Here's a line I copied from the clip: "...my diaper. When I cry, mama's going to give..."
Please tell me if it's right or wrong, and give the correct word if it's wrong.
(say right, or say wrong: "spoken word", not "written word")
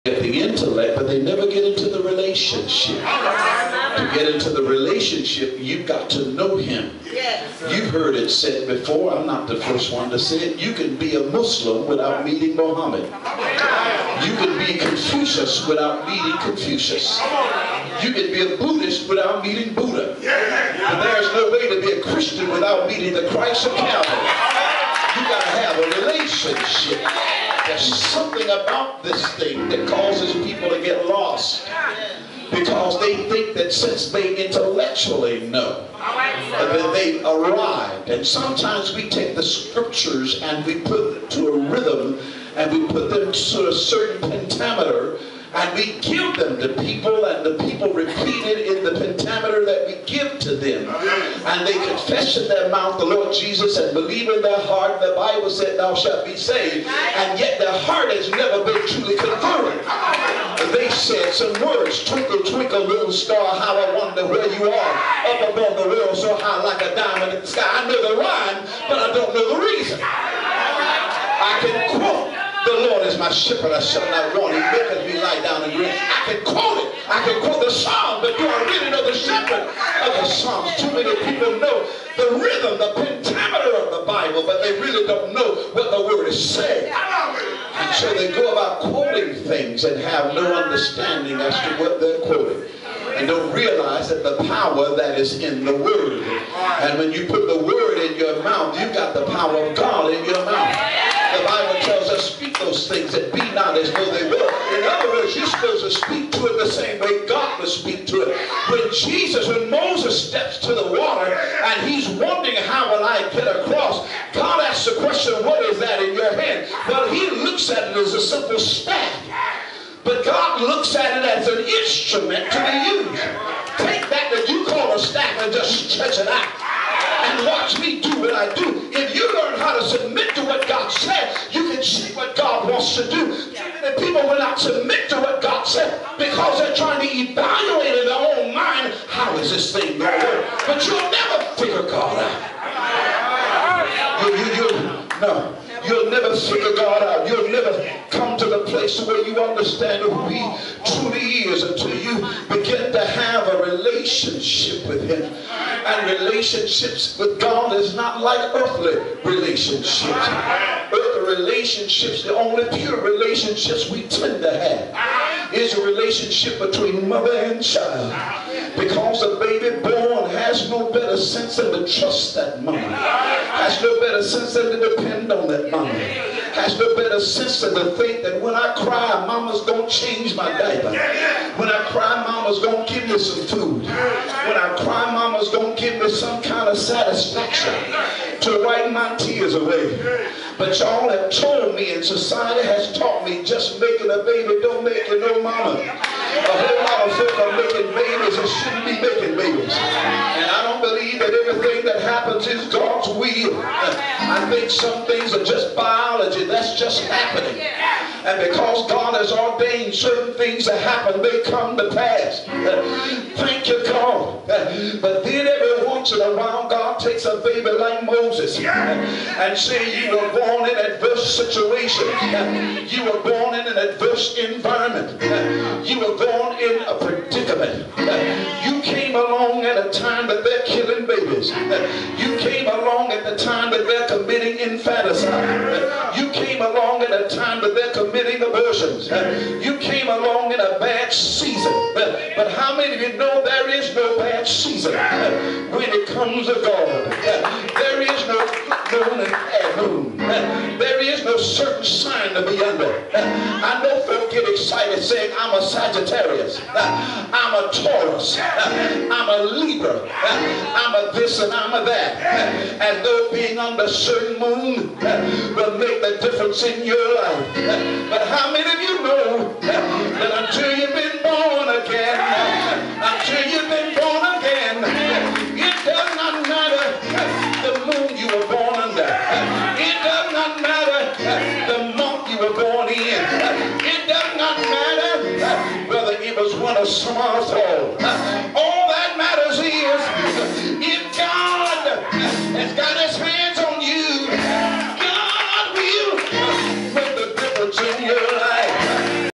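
right.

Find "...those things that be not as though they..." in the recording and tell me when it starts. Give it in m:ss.
1:42.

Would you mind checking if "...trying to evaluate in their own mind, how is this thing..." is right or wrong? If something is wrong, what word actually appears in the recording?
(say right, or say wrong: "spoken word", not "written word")
right.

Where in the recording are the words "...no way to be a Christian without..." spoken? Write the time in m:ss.
0:21.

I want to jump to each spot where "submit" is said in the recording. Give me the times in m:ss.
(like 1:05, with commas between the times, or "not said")
2:09, 2:14.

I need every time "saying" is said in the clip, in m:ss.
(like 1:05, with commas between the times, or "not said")
1:26, 4:15.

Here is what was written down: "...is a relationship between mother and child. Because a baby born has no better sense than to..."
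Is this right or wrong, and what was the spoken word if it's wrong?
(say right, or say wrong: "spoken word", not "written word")
right.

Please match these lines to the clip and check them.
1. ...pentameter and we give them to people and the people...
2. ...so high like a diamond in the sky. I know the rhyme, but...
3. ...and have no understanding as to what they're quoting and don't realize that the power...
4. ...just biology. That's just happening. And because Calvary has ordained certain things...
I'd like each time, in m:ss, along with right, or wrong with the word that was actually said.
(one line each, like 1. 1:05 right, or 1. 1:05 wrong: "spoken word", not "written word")
1. 0:44 right
2. 1:06 right
3. 1:29 right
4. 3:25 wrong: "God", not "Calvary".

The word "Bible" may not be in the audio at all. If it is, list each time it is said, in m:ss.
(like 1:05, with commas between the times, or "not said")
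0:55, 1:24, 1:41.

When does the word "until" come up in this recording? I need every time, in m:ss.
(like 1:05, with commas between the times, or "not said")
2:31, 4:30.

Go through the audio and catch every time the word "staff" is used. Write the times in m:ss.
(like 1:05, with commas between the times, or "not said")
1:58, 2:04.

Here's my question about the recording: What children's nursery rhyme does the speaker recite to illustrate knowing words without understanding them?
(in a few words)
Twinkle, Twinkle, Little Star.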